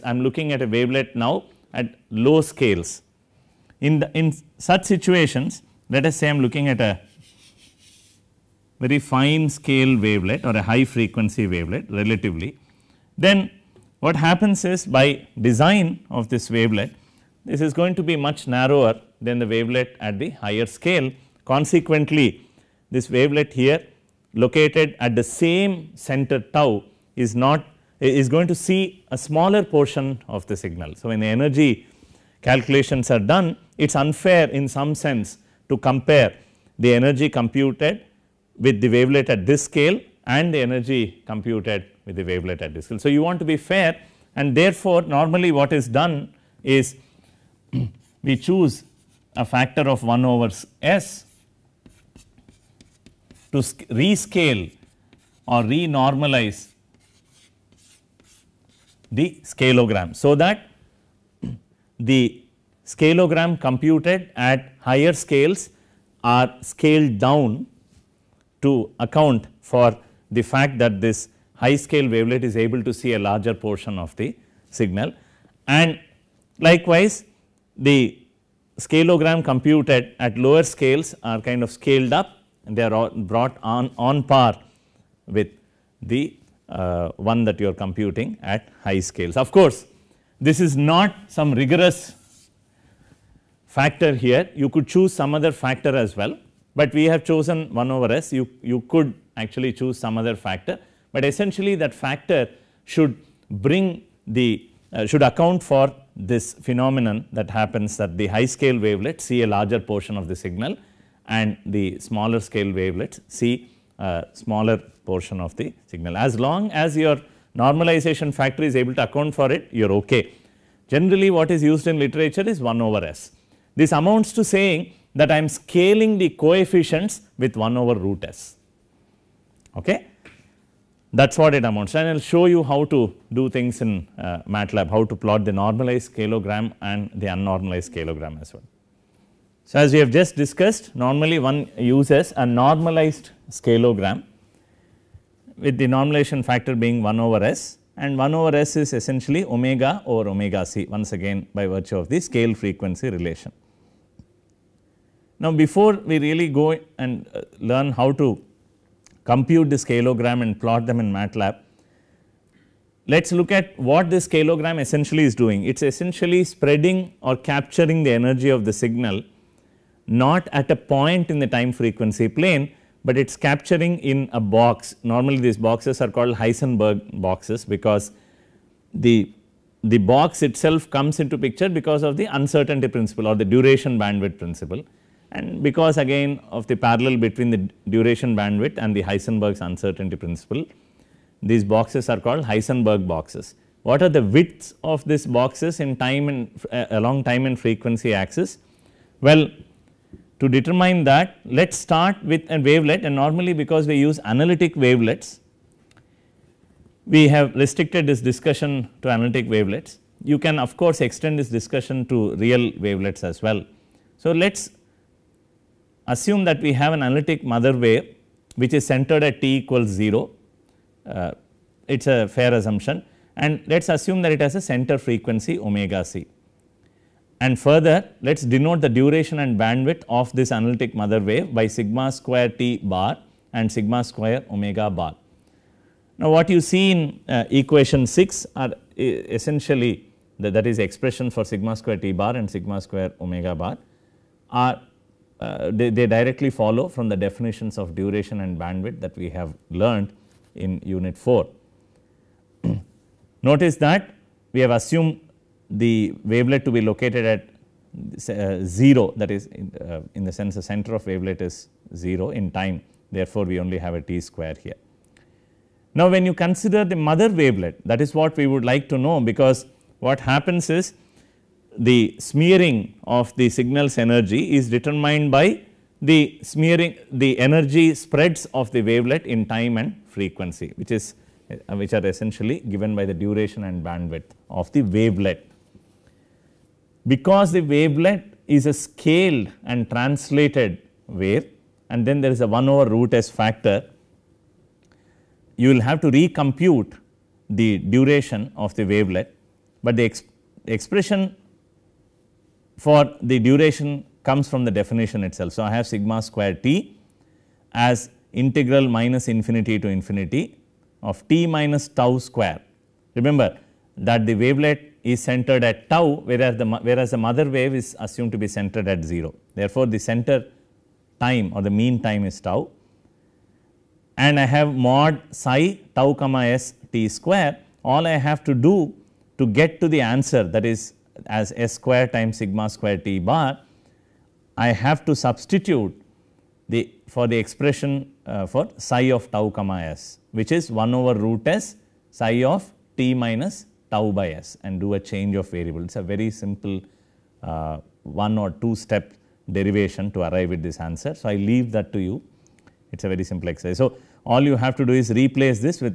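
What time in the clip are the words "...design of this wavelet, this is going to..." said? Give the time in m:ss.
0:15.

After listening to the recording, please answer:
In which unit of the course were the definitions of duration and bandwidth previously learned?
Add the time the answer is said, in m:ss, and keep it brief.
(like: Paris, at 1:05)
unit 4, at 4:10.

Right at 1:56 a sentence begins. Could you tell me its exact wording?
As long as your normalization factor is able to account for it, you are okay.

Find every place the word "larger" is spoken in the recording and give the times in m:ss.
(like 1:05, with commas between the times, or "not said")
1:13, 1:49.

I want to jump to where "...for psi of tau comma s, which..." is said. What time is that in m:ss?
5:38.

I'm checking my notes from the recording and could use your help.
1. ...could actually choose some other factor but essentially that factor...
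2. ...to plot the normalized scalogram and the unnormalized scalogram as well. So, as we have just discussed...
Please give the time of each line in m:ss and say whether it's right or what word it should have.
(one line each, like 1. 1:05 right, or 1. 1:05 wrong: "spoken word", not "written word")
1. 1:38 right
2. 2:15 right.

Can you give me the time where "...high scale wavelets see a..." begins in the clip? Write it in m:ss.
1:48.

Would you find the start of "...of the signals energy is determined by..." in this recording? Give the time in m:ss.
4:33.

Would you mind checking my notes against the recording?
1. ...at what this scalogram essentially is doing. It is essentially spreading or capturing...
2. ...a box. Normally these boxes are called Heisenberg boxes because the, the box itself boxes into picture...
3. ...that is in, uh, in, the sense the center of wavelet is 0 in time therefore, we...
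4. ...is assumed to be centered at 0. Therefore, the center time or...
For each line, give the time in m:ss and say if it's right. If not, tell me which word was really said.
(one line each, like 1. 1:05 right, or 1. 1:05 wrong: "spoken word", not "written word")
1. 2:43 right
2. 2:54 wrong: "comes", not "boxes"
3. 4:19 right
4. 5:17 right.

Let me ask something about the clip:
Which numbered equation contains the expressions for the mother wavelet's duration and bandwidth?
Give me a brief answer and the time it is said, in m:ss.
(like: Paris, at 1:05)
equation 6, at 3:57.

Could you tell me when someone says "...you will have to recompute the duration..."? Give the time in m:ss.
4:55.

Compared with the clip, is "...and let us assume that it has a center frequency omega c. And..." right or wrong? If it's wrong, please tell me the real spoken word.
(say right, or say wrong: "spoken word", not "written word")
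right.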